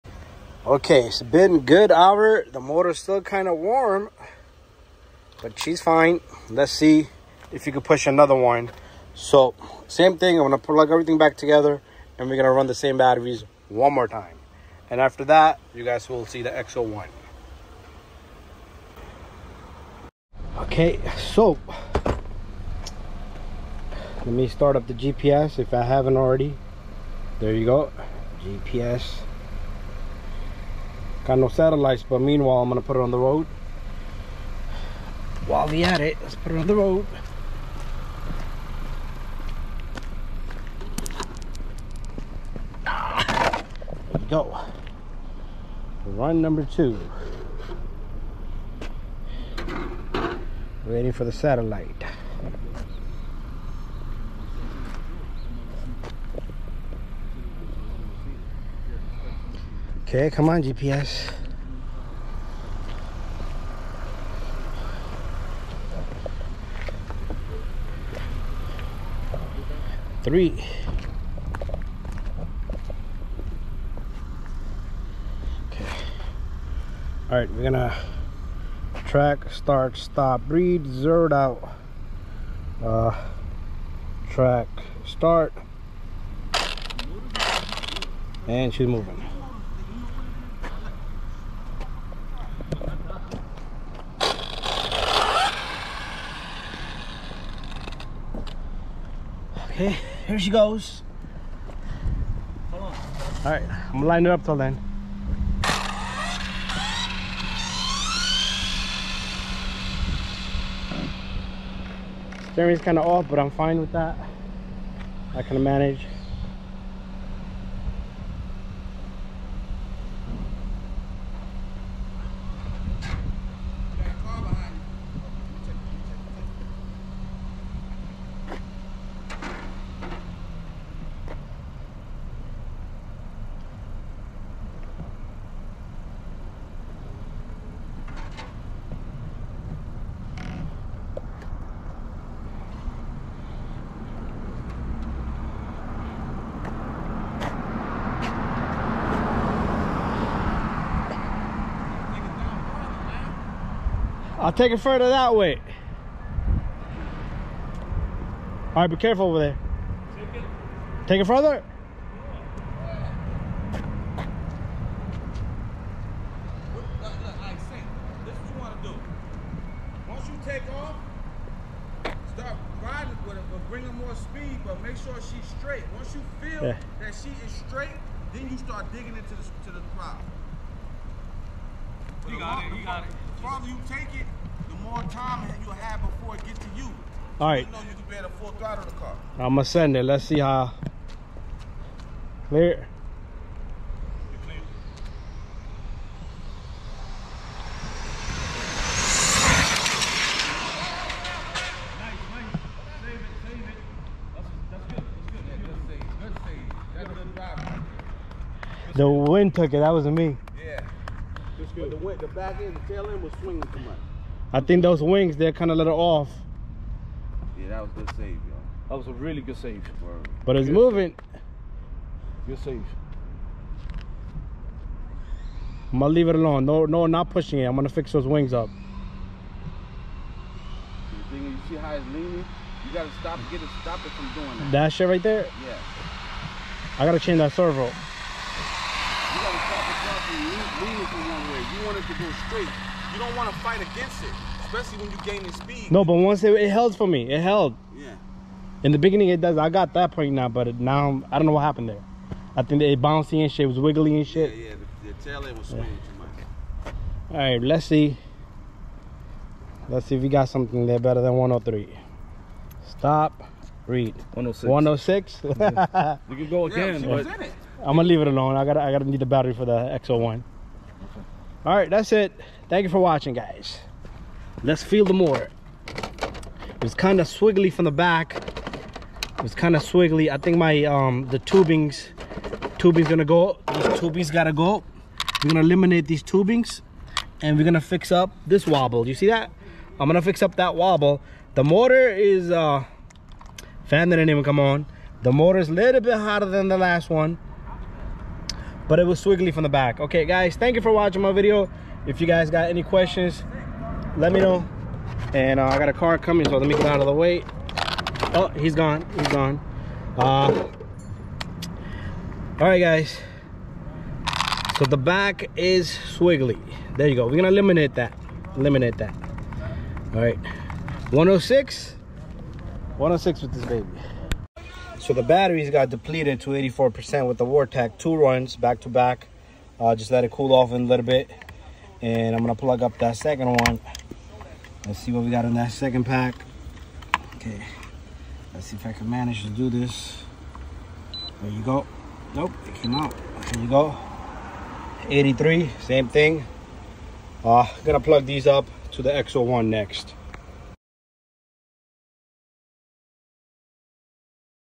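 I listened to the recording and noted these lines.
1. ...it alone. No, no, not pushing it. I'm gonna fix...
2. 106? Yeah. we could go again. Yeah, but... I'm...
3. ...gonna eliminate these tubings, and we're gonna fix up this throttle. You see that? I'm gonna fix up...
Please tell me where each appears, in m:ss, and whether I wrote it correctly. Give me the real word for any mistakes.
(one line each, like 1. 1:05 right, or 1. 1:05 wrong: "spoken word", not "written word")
1. 3:46 right
2. 4:24 right
3. 4:45 wrong: "wobble", not "throttle".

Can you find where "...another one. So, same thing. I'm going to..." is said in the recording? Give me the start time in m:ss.
0:08.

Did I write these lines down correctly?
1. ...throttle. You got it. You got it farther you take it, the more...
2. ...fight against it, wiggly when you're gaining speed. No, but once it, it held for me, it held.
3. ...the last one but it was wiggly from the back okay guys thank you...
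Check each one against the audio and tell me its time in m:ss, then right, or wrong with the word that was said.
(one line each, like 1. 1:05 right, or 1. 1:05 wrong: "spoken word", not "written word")
1. 2:59 right
2. 4:03 wrong: "especially", not "wiggly"
3. 4:56 wrong: "swiggly", not "wiggly".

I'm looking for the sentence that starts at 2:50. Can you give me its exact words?
take off, start riding with it, but bring her more speed, but make sure she's straight.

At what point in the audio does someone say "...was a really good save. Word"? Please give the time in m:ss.
3:38.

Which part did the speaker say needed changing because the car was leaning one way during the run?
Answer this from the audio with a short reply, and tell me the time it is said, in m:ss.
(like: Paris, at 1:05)
servo, at 3:57.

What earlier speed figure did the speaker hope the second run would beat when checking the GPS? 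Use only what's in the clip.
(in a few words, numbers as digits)
103.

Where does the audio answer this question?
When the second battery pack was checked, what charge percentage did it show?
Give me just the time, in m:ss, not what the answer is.
5:45.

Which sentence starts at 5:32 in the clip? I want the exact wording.
And I'm going to plug up that second one.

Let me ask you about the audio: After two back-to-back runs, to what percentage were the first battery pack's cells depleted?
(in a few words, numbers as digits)
84%.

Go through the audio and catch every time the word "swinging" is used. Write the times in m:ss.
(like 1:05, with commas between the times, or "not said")
3:33, 4:15.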